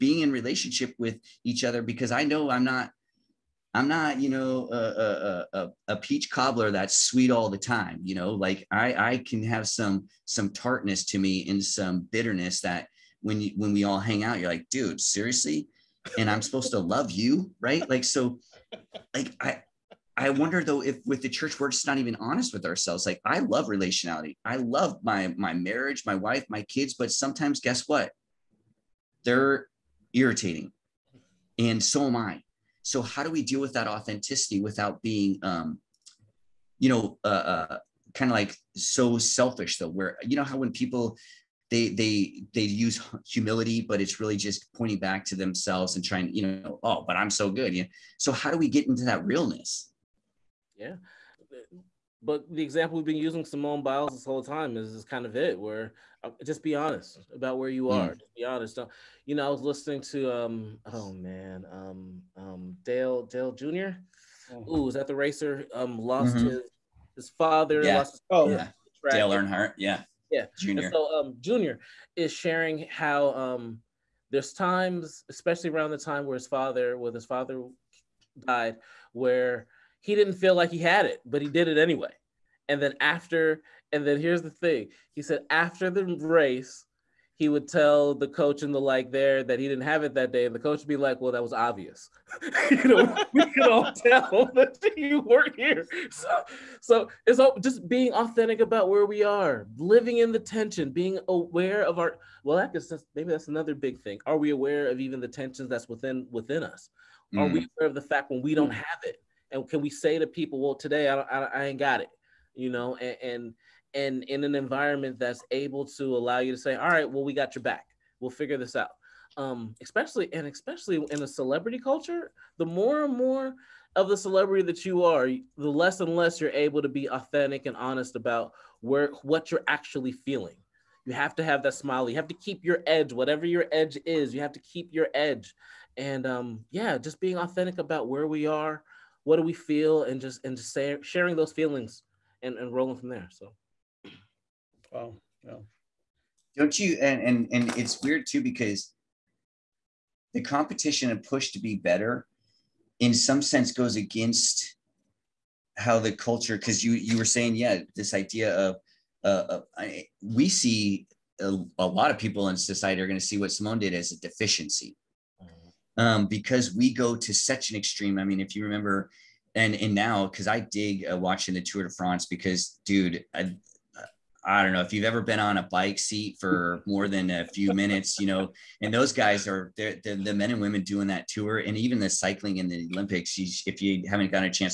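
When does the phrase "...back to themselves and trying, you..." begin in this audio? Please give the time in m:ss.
0:44.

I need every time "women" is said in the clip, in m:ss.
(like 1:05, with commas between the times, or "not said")
3:00.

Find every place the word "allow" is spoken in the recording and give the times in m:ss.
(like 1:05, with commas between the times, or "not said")
1:56.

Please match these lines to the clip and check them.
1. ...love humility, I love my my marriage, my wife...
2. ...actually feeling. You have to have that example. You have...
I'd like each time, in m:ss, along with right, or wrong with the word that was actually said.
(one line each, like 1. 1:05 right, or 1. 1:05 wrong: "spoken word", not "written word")
1. 0:23 wrong: "relationality", not "humility"
2. 2:09 wrong: "smile", not "example".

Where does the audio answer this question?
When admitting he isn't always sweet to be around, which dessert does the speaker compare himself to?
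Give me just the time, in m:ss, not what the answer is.
0:05.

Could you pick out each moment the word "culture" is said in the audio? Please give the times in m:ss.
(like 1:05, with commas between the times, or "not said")
2:01, 2:36.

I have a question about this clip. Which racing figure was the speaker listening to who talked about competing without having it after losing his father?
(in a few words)
Dale Jr.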